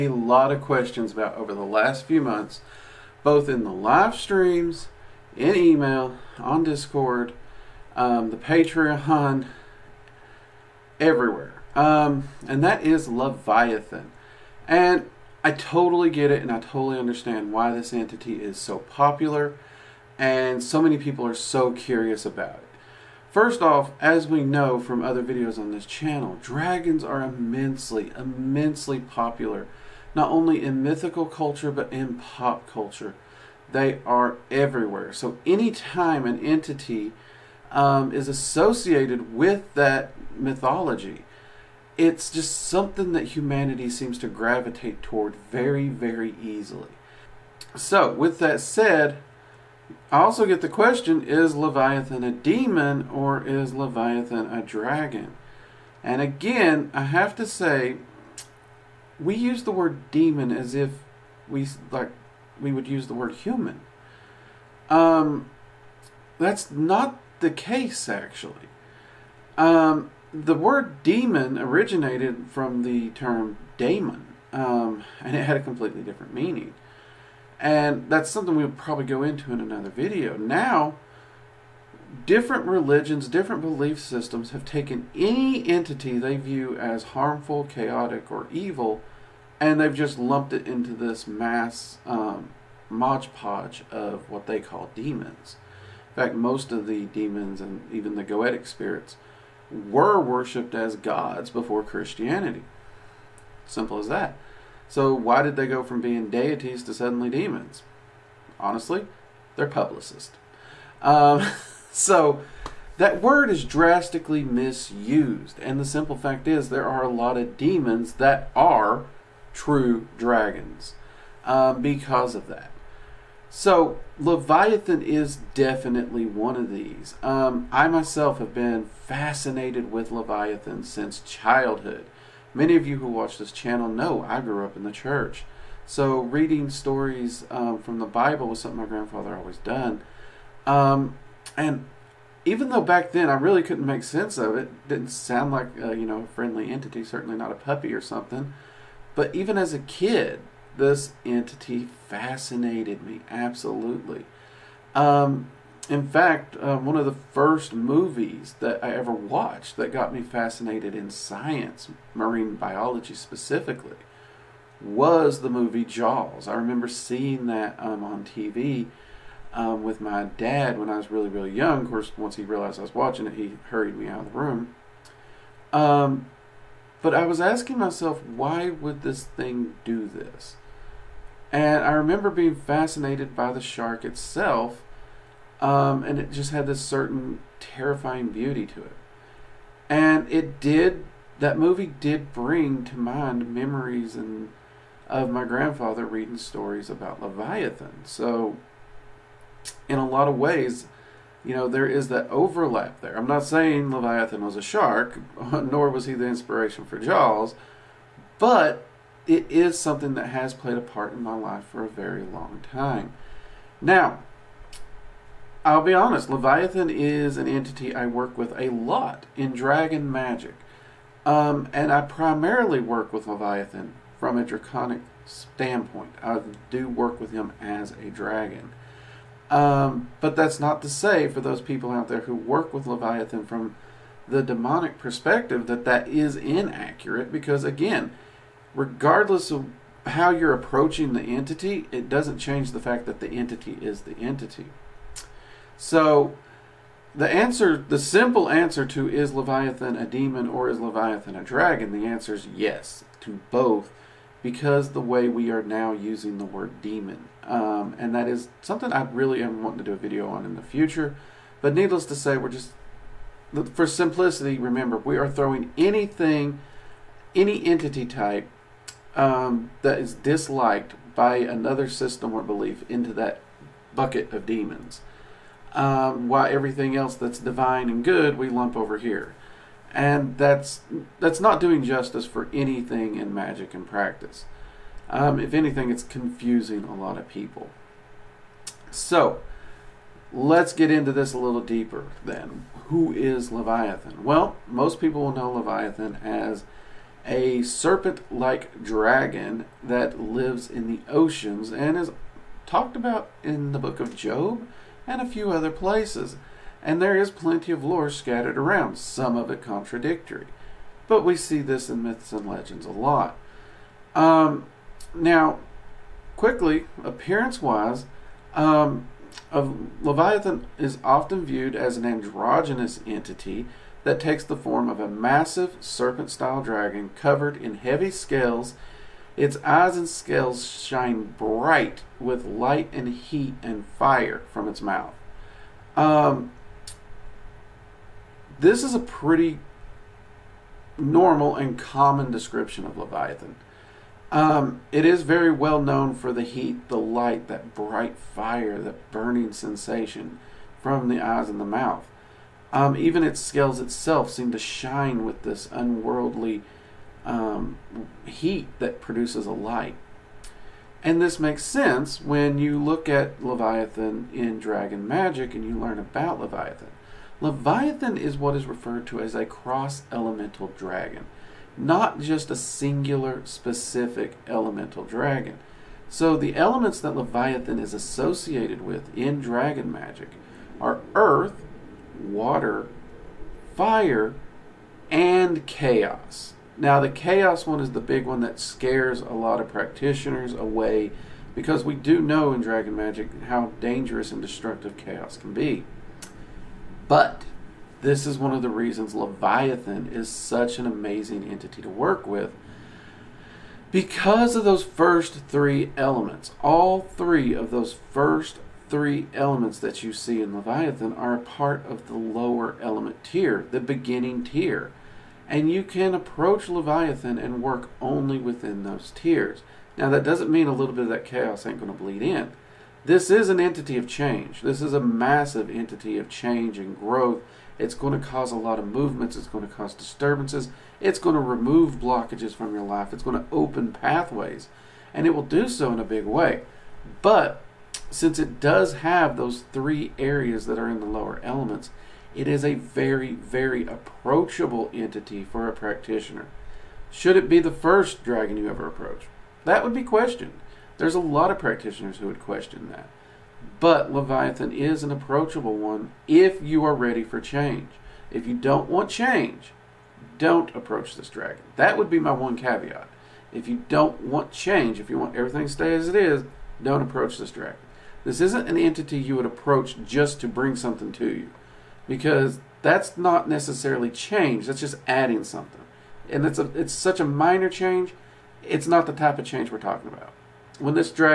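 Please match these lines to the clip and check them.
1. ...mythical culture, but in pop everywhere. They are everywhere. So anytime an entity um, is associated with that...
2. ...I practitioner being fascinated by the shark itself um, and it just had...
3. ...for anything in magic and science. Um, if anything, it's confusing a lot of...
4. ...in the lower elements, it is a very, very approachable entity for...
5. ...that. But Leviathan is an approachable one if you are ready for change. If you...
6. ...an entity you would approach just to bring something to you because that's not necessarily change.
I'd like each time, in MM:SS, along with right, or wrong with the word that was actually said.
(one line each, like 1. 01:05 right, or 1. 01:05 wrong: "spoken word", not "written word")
1. 00:30 wrong: "culture", not "everywhere"
2. 03:01 wrong: "remember", not "practitioner"
3. 04:42 wrong: "practice", not "science"
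4. 07:20 right
5. 07:32 right
6. 07:48 right.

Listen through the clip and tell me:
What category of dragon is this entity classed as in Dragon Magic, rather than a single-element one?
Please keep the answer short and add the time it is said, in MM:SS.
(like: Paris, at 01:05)
cross elemental dragon, at 06:09.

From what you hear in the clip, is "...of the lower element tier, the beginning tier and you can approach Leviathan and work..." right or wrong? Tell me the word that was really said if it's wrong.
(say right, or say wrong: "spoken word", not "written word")
right.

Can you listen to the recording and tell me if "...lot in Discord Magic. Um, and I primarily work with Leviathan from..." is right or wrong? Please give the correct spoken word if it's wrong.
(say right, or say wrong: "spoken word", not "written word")
wrong: "Dragon", not "Discord".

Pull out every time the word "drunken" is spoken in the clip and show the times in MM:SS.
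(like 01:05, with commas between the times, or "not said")
not said.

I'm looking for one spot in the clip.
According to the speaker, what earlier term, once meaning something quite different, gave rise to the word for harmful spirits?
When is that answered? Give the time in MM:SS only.
01:13.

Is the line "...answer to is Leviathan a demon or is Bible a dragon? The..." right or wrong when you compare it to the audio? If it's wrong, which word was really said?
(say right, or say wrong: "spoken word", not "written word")
wrong: "Leviathan", not "Bible".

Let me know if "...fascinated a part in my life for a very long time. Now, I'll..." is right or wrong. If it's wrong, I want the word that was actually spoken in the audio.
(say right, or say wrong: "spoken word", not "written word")
wrong: "played", not "fascinated".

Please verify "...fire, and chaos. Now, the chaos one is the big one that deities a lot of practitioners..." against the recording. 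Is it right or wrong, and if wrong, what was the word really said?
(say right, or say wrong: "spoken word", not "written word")
wrong: "scares", not "deities".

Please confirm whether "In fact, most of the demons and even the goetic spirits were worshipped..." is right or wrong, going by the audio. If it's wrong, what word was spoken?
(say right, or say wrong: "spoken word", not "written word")
right.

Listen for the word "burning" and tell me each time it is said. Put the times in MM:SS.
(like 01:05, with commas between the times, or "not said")
05:49.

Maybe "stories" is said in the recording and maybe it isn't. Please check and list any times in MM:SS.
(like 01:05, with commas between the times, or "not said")
02:16, 03:16.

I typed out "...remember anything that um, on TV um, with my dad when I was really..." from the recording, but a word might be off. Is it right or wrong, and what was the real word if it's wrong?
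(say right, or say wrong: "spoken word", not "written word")
wrong: "seeing", not "anything".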